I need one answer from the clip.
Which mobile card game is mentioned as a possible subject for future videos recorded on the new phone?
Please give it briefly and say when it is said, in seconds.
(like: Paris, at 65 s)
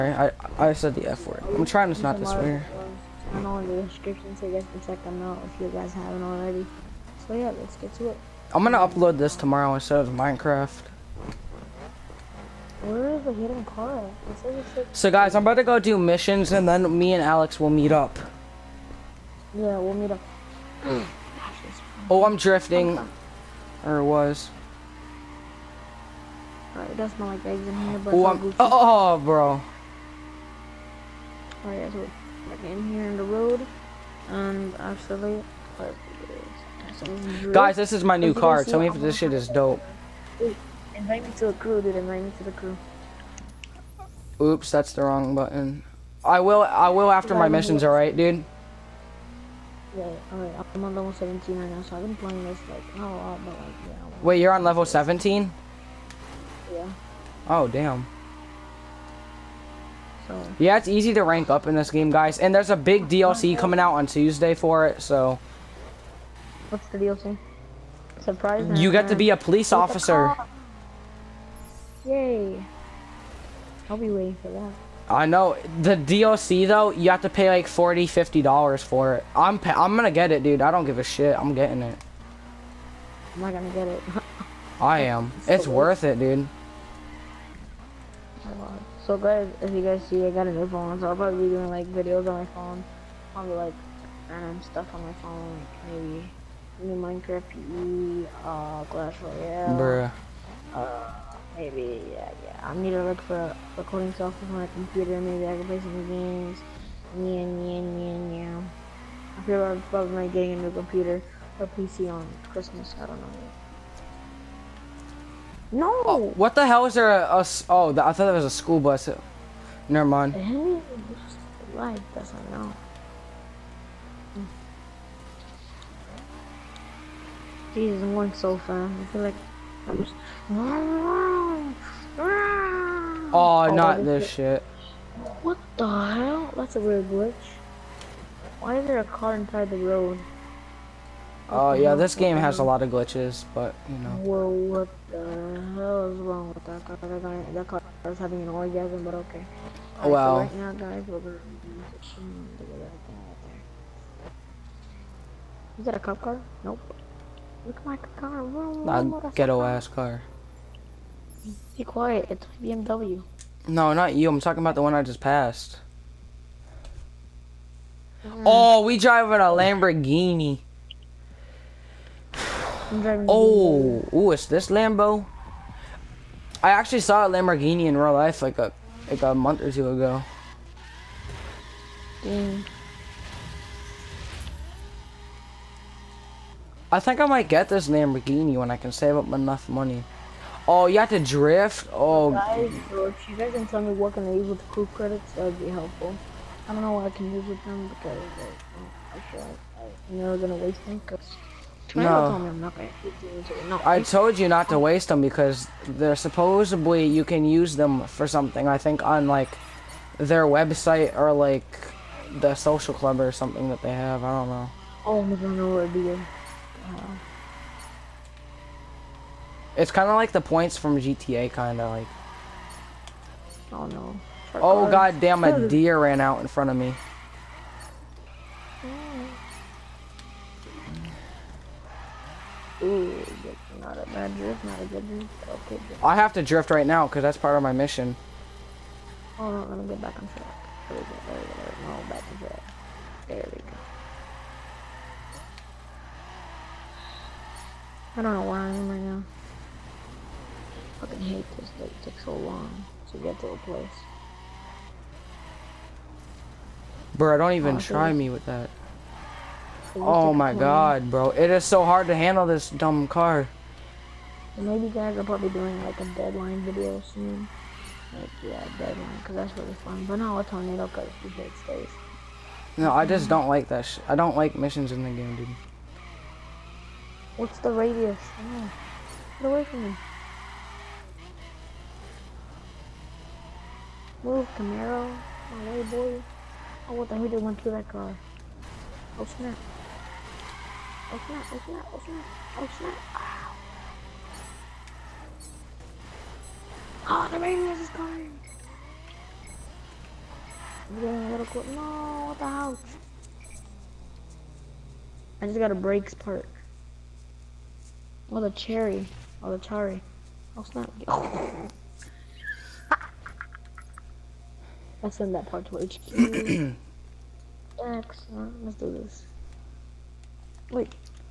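Clash Royale, at 98 s.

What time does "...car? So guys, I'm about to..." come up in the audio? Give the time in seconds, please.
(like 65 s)
13 s.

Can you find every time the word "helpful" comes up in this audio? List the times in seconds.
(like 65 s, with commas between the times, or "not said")
195 s.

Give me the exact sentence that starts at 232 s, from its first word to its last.
Ooh, not a bad drift, not a good drift.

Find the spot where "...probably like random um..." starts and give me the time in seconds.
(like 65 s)
93 s.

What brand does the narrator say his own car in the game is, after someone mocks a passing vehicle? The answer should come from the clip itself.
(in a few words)
BMW.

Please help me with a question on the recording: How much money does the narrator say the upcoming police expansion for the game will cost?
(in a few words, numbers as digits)
$40.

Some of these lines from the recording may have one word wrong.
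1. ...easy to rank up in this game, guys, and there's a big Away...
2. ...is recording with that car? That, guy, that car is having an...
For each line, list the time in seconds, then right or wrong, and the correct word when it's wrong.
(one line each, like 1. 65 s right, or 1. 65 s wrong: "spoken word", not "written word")
1. 60 s wrong: "DLC", not "Away"
2. 146 s wrong: "wrong", not "recording".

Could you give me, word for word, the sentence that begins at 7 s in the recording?
So yeah, let's get to it.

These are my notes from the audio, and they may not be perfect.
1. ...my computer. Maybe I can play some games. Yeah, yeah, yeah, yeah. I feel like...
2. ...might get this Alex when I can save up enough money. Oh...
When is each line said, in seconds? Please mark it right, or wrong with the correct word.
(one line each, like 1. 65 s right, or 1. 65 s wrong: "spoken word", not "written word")
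1. 104 s right
2. 187 s wrong: "Lamborghini", not "Alex".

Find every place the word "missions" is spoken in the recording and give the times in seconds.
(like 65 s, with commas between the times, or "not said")
15 s, 47 s, 237 s, 274 s.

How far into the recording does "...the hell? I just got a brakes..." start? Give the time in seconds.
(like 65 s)
302 s.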